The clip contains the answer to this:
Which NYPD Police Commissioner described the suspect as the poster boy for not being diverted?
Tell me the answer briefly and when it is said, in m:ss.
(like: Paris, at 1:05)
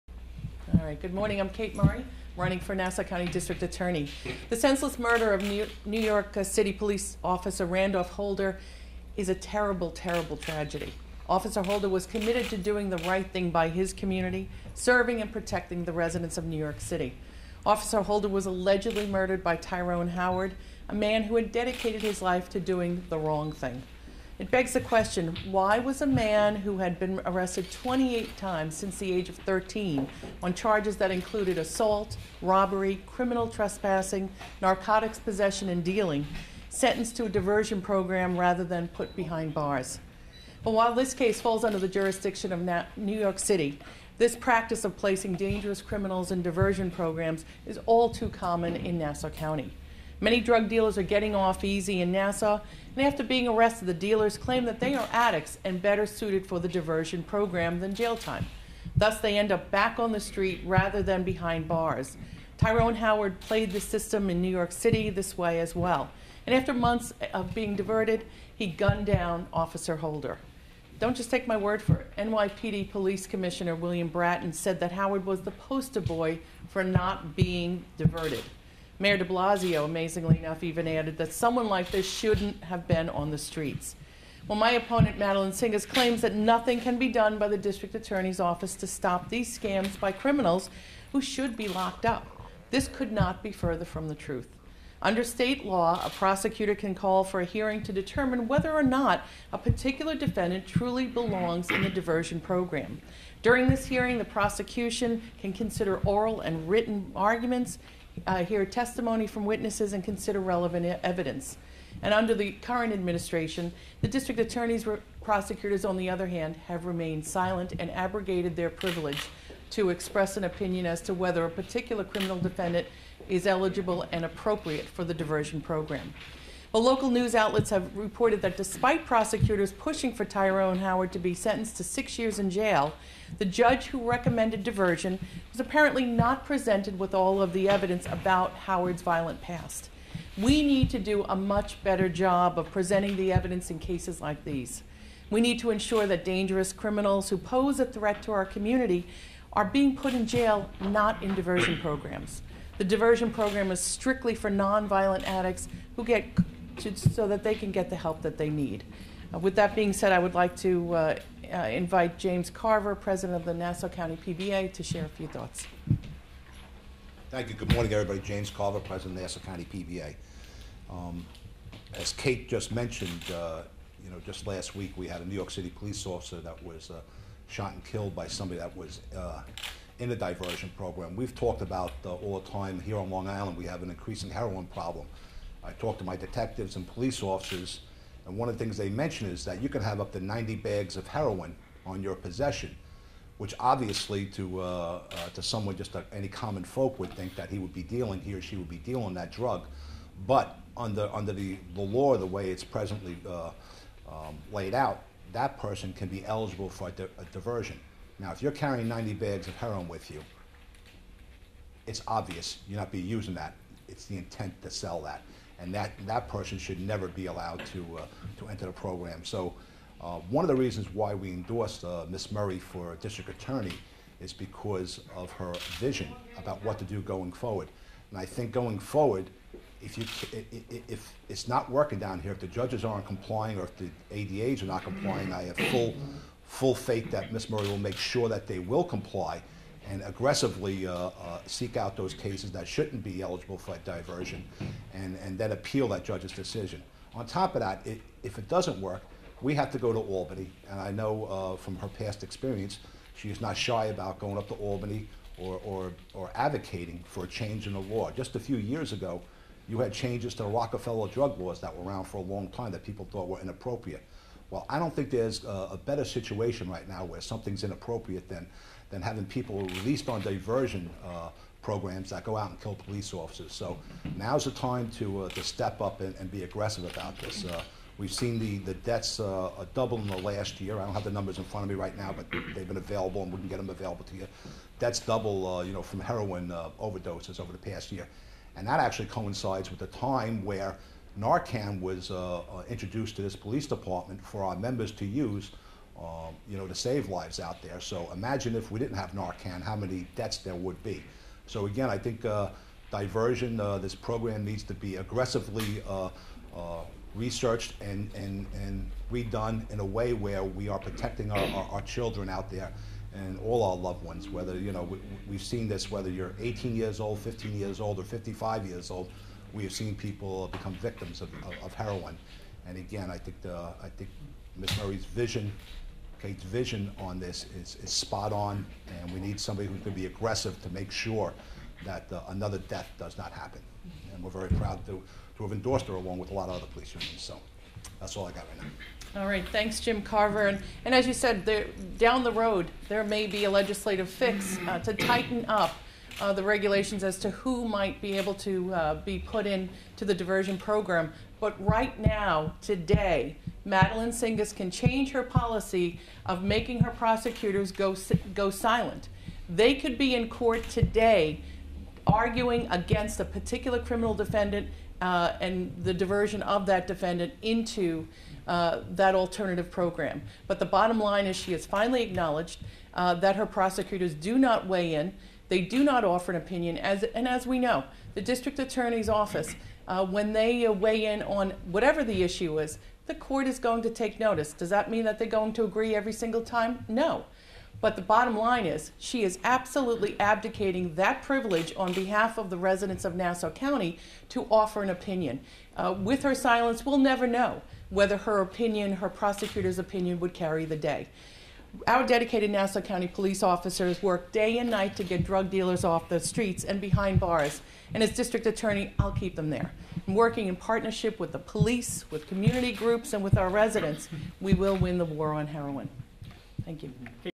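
William Bratton, at 1:13.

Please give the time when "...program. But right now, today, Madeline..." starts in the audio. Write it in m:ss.
5:50.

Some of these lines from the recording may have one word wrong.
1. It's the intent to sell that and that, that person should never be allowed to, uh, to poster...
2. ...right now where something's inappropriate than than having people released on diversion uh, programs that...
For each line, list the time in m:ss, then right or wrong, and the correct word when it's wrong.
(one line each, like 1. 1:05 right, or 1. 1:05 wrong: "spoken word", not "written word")
1. 3:33 wrong: "enter", not "poster"
2. 4:26 right.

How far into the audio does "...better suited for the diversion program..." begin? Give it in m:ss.
0:55.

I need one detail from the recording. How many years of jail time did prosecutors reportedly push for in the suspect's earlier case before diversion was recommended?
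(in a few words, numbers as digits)
6.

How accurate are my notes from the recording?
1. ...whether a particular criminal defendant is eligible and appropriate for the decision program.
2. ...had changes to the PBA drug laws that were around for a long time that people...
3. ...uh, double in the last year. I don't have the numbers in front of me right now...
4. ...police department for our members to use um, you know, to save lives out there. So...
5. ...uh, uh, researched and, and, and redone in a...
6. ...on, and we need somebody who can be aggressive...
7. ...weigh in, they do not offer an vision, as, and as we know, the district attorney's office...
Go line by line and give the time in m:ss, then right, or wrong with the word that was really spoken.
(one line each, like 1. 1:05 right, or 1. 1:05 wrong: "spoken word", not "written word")
1. 2:01 wrong: "diversion", not "decision"
2. 4:19 wrong: "Rockefeller", not "PBA"
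3. 4:39 right
4. 4:53 right
5. 5:05 right
6. 5:28 right
7. 6:14 wrong: "opinion", not "vision".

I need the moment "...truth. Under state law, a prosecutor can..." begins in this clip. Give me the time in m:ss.
1:34.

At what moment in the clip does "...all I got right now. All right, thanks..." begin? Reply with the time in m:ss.
5:38.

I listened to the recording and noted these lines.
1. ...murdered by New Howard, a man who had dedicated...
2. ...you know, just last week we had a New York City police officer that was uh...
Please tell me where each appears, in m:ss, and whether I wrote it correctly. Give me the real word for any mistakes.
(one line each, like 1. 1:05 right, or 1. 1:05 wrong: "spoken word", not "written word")
1. 0:19 wrong: "Tyrone", not "New"
2. 2:54 right.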